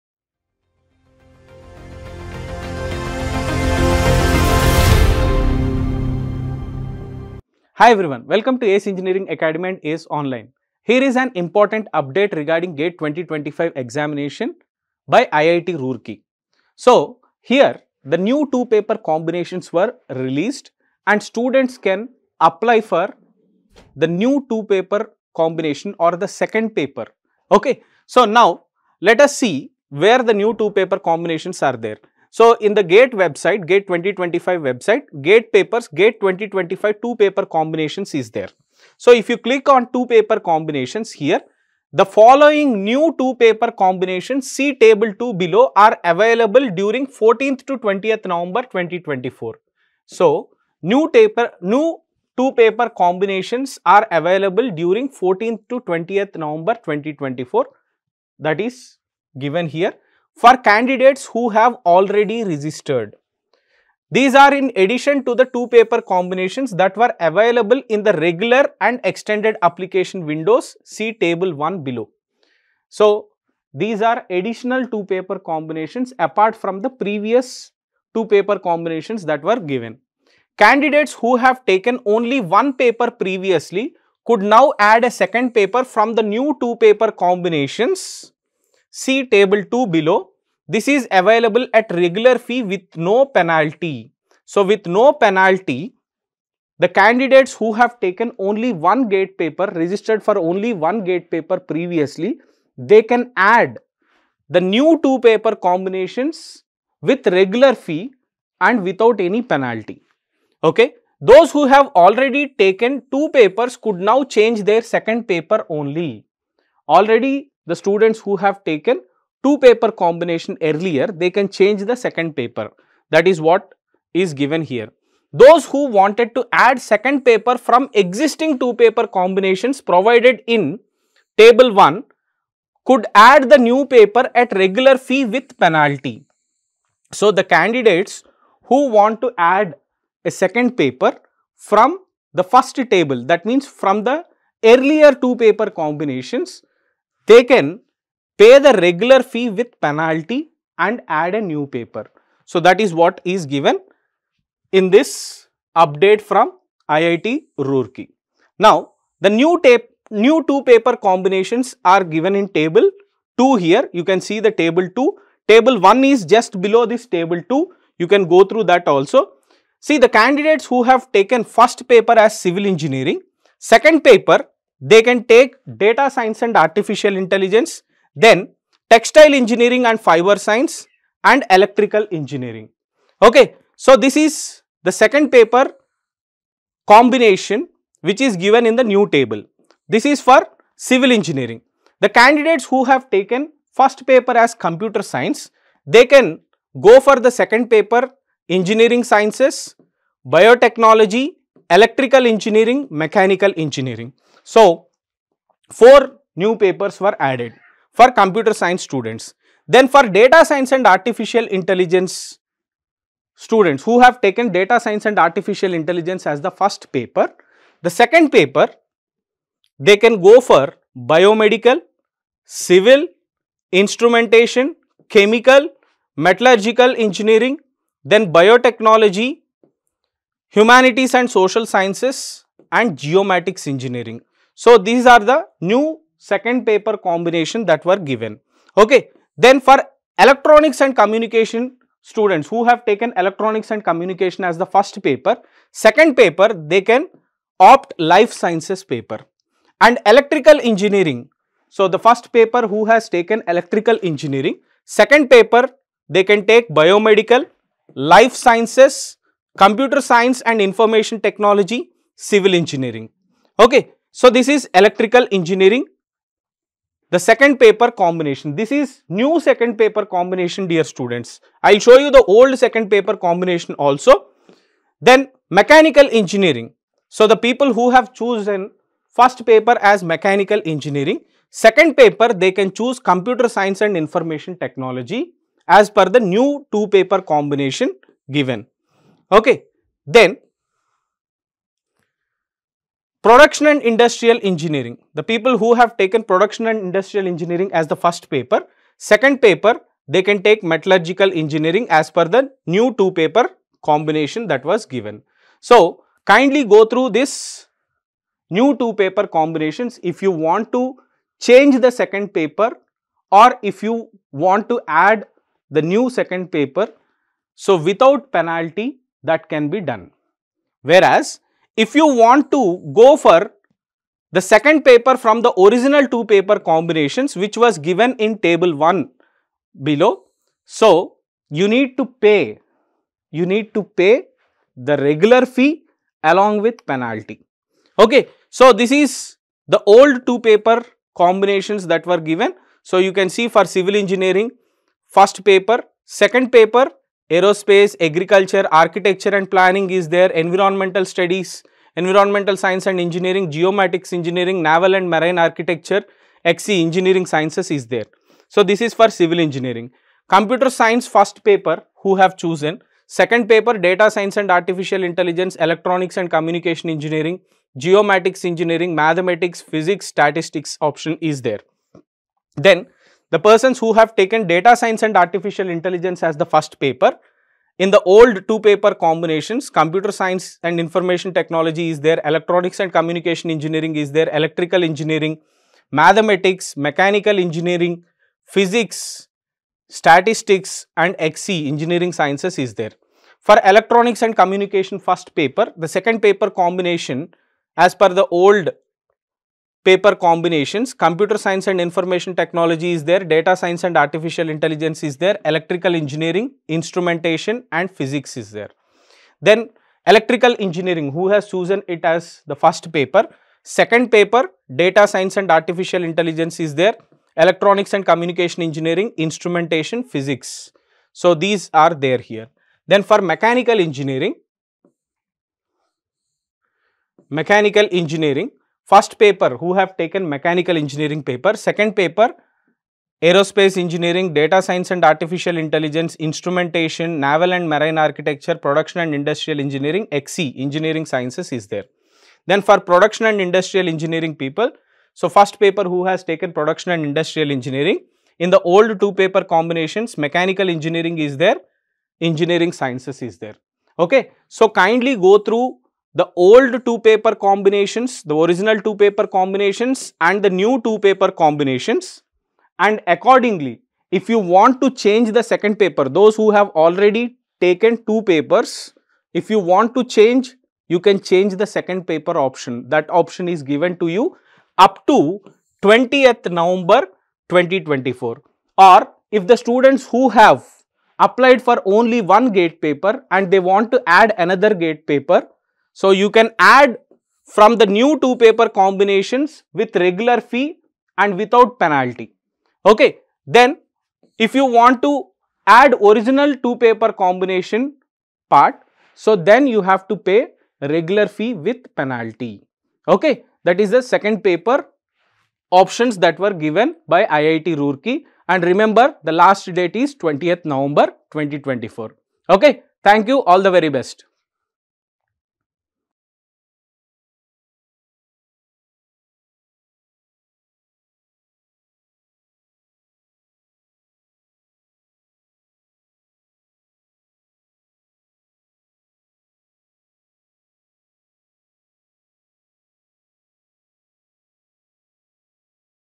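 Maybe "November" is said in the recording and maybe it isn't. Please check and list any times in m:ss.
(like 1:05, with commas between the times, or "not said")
0:48, 0:56, 7:56, 8:30.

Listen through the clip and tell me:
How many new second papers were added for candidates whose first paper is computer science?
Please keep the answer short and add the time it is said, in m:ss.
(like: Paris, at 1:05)
4, at 3:25.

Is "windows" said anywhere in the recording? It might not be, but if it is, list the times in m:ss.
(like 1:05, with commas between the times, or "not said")
1:10.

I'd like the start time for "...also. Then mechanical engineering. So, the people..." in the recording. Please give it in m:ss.
4:33.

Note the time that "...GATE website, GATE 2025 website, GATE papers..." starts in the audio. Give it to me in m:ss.
0:32.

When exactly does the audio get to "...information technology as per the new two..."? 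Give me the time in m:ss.
4:43.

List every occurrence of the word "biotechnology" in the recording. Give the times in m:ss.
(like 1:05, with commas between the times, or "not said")
3:20, 3:48.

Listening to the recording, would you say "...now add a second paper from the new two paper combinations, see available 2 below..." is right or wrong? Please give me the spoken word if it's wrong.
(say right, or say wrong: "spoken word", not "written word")
wrong: "table", not "available".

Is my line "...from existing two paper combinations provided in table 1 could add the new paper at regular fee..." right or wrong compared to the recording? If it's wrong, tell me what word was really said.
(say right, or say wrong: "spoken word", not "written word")
right.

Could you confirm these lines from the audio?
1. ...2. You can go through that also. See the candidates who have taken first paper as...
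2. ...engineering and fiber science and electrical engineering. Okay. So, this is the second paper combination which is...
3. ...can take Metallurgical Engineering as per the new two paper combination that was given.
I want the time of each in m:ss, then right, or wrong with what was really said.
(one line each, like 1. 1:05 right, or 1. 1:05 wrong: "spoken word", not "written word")
1. 2:47 right
2. 2:59 right
3. 5:00 right.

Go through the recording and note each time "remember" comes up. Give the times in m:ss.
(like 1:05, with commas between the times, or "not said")
8:28.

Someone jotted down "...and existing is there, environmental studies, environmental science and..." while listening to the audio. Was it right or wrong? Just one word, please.
wrong.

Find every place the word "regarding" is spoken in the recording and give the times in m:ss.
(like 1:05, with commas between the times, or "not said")
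0:12.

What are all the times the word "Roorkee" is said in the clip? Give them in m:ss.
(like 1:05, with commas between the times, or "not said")
0:15, 2:37, 8:27.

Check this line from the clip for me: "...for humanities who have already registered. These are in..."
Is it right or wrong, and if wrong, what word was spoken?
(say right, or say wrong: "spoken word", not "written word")
wrong: "candidates", not "humanities".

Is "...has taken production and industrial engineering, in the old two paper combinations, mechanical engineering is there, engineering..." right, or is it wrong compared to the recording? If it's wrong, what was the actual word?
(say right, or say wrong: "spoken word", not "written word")
right.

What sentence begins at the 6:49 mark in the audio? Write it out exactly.
Then electrical engineering, who has chosen it as the first paper?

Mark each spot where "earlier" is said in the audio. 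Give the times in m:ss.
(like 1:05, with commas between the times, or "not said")
2:00, 2:24.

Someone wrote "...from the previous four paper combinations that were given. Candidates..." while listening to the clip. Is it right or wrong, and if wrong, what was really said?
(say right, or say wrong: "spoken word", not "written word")
wrong: "two", not "four".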